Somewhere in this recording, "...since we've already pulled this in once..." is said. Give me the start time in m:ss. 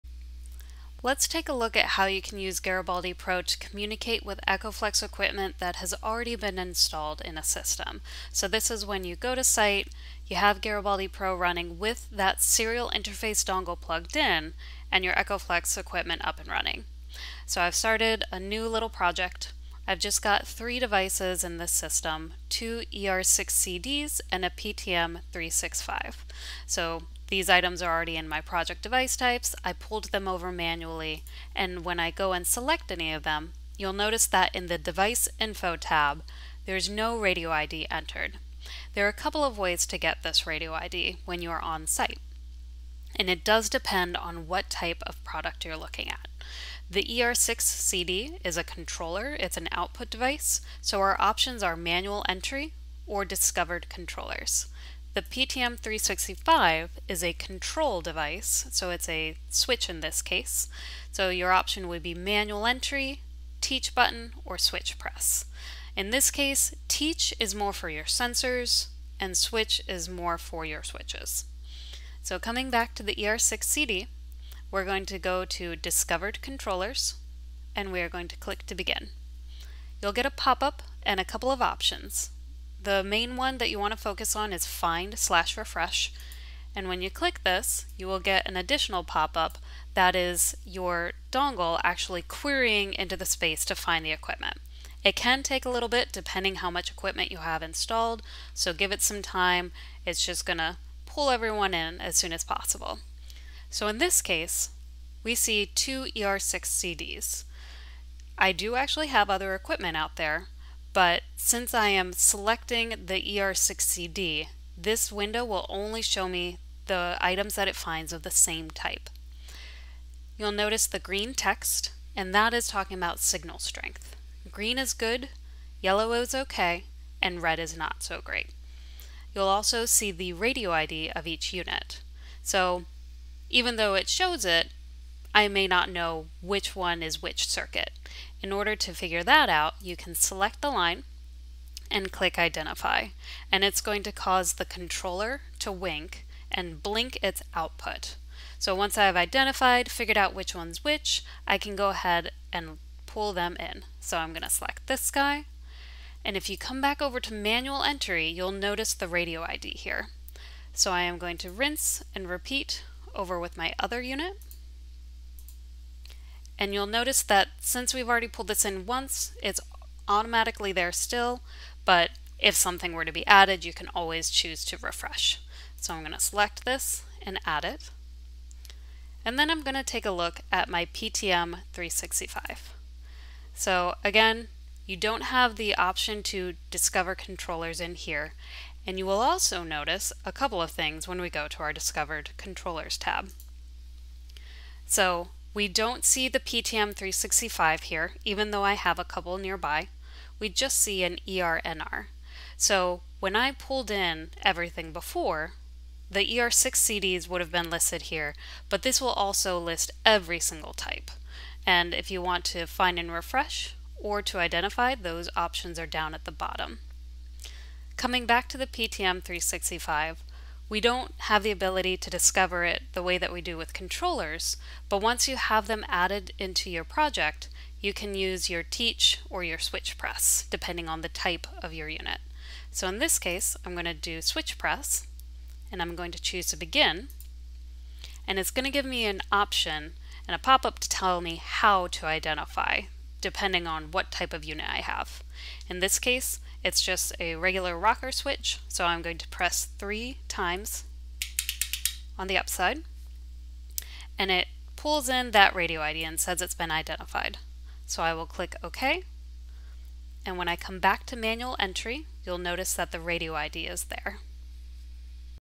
2:47.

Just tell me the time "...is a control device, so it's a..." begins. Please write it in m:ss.
0:57.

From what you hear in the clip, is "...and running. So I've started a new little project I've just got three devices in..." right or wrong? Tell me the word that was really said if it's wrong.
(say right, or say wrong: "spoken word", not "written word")
right.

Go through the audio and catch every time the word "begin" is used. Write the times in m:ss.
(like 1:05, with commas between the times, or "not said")
1:18, 3:56.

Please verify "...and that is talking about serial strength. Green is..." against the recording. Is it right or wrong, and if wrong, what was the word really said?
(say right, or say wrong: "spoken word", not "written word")
wrong: "signal", not "serial".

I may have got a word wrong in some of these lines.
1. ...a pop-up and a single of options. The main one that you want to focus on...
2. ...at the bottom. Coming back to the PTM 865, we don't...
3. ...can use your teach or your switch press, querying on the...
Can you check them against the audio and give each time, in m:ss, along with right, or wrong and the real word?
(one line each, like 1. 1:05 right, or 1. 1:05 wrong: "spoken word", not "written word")
1. 1:20 wrong: "couple", not "single"
2. 3:36 wrong: "365", not "865"
3. 3:47 wrong: "depending", not "querying".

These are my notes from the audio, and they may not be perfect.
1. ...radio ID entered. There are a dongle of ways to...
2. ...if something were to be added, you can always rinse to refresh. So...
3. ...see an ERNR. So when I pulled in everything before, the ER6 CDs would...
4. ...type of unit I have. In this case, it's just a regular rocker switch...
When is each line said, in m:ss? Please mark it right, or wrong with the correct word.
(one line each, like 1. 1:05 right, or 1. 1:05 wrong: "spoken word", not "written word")
1. 0:37 wrong: "couple", not "dongle"
2. 2:52 wrong: "choose", not "rinse"
3. 3:20 right
4. 4:04 right.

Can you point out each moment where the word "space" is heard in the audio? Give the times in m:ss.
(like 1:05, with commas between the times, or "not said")
1:33.